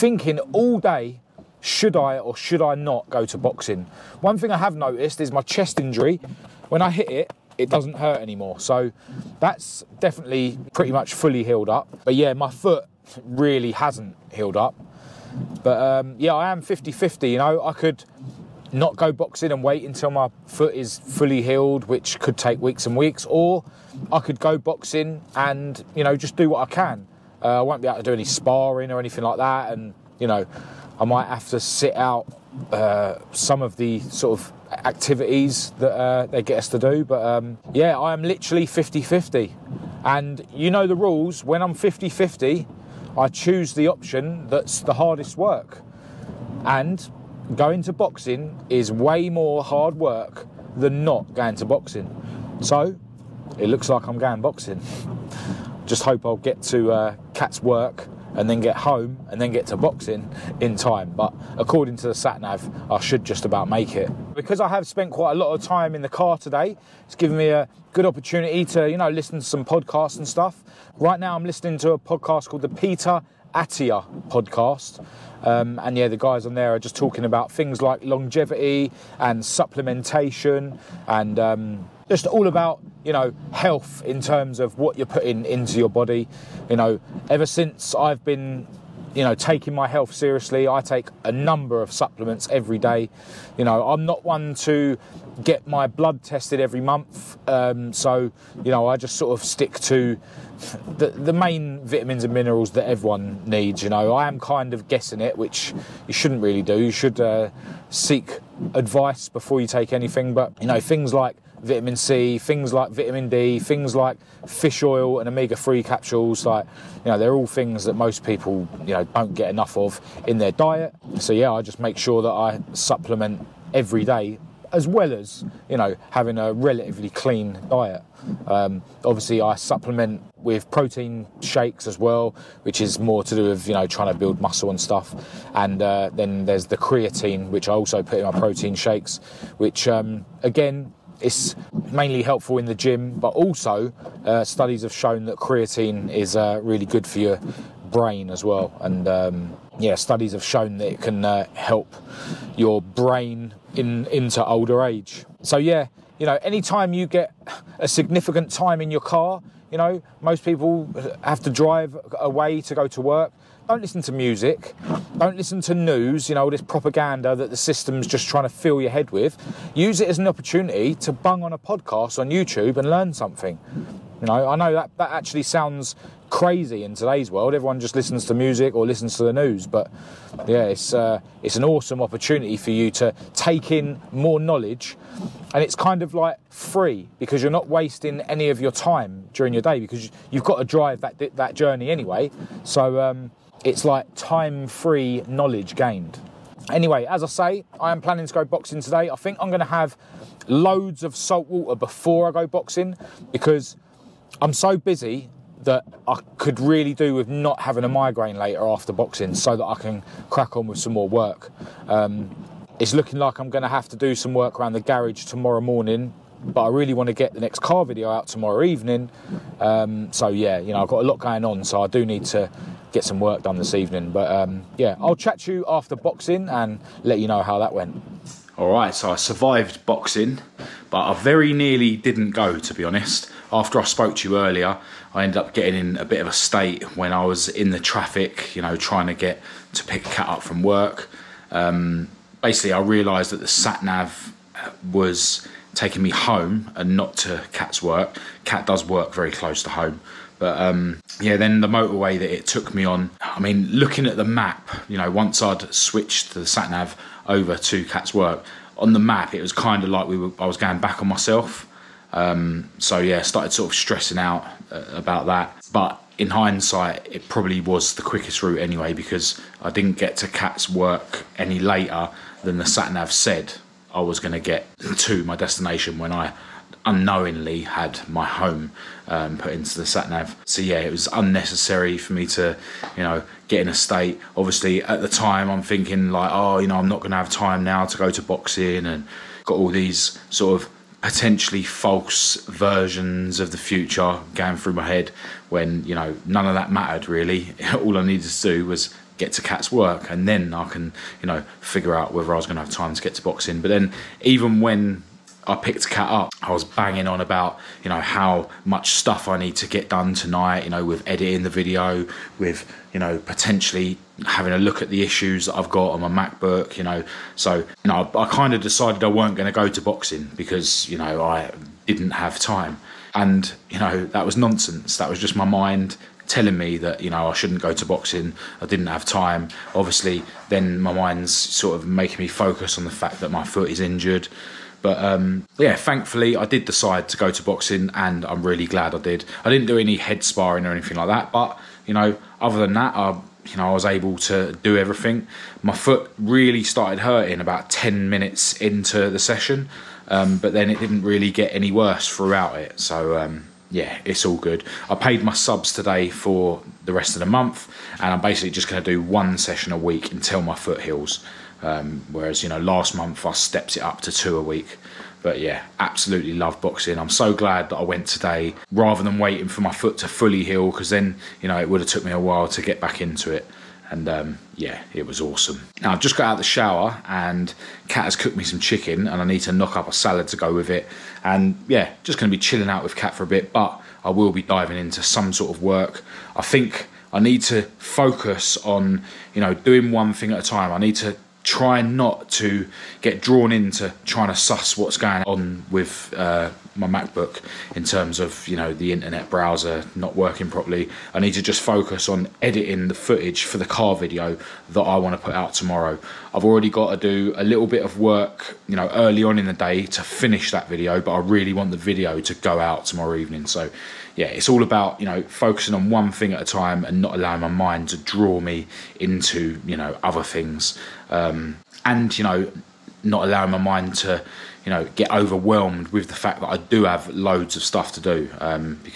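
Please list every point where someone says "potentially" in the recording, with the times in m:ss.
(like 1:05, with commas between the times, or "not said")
4:51, 5:13.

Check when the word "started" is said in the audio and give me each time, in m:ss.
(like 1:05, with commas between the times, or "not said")
4:23, 5:46.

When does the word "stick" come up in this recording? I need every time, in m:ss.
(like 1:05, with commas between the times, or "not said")
1:39.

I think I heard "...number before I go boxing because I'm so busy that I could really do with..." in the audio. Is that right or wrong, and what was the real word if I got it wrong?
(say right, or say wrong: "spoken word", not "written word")
wrong: "water", not "number".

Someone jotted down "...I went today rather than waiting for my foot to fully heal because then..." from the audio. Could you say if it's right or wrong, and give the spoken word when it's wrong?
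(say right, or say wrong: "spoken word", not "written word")
right.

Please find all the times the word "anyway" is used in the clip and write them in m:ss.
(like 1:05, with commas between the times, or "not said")
3:11, 3:16, 4:28.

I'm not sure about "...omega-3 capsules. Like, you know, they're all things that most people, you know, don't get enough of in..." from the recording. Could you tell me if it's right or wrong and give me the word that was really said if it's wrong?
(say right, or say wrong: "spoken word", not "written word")
right.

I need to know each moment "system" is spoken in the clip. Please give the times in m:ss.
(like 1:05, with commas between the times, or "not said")
2:47.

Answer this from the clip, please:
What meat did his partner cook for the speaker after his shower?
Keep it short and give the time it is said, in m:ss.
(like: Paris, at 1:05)
Chicken, at 6:18.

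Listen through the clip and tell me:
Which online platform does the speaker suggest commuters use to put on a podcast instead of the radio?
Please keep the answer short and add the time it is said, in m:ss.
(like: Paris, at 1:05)
YouTube, at 2:52.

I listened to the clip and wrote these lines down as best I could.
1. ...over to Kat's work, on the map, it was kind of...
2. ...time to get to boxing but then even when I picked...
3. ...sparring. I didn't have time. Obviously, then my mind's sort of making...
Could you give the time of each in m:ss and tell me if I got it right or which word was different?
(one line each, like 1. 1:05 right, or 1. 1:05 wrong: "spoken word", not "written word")
1. 4:17 wrong: "Cat", not "Kat"
2. 5:02 right
3. 5:27 wrong: "boxing", not "sparring".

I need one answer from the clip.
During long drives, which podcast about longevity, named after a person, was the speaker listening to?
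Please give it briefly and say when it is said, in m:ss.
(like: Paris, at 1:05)
Peter Attia podcast, at 1:12.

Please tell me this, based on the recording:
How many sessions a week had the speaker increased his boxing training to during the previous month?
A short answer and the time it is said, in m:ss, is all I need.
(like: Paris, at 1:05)
2, at 6:04.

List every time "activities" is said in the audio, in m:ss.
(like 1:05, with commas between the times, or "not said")
0:34.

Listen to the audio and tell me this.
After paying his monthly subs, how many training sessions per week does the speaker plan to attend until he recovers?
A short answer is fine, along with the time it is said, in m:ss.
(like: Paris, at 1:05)
1, at 5:59.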